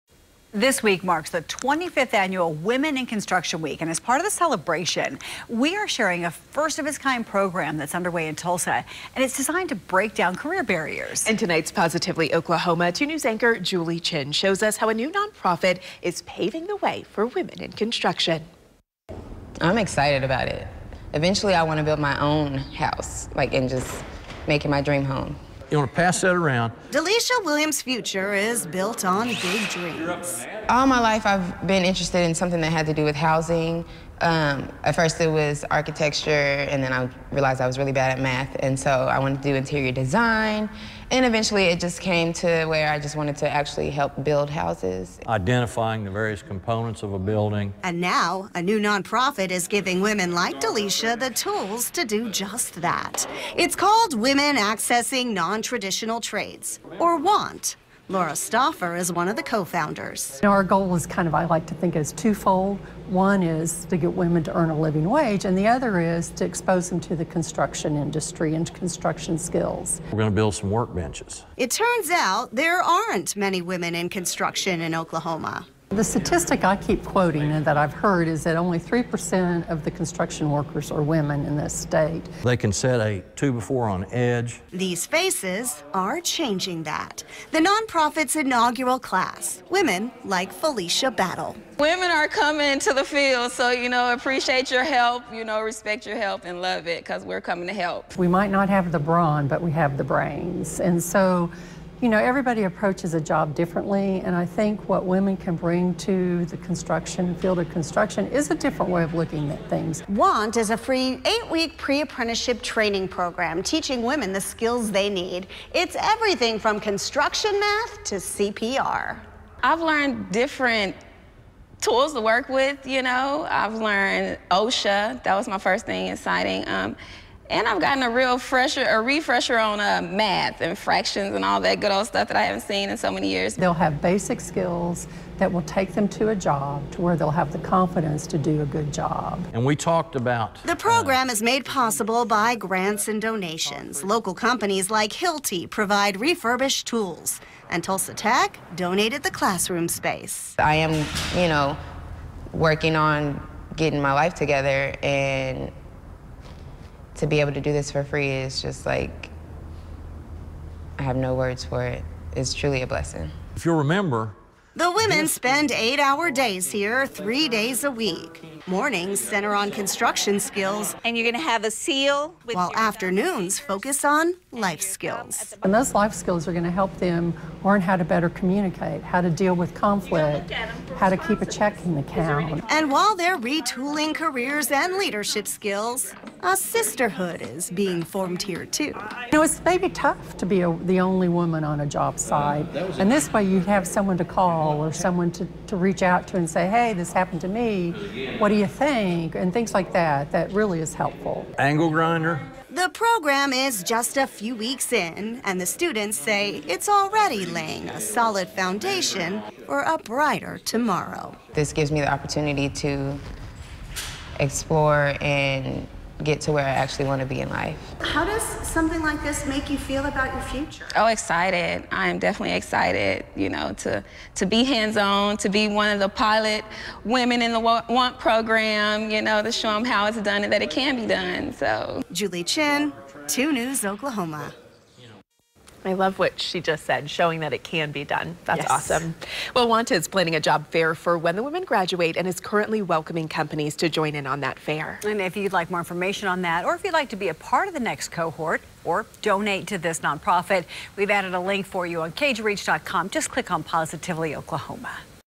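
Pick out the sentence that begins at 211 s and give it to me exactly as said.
This gives me the opportunity to explore and get to where I actually want to be in life.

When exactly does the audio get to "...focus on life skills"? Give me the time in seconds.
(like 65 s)
173 s.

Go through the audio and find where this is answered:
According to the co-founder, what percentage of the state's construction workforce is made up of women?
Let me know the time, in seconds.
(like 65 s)
78 s.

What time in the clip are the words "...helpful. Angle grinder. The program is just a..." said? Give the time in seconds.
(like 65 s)
200 s.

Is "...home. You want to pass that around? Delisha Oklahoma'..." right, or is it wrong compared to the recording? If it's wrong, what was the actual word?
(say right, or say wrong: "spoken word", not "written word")
wrong: "Williams", not "Oklahoma".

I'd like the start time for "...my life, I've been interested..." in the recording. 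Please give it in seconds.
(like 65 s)
30 s.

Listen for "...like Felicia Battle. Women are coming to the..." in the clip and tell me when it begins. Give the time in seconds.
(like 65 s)
90 s.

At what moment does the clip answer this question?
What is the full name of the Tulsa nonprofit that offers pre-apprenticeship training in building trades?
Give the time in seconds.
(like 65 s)
54 s.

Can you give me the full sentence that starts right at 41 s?
And eventually it just came to where I just wanted to actually help build houses.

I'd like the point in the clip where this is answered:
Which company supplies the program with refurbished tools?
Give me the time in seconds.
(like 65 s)
145 s.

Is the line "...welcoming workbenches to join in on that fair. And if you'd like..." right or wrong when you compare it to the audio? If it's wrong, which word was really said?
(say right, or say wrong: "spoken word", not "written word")
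wrong: "companies", not "workbenches".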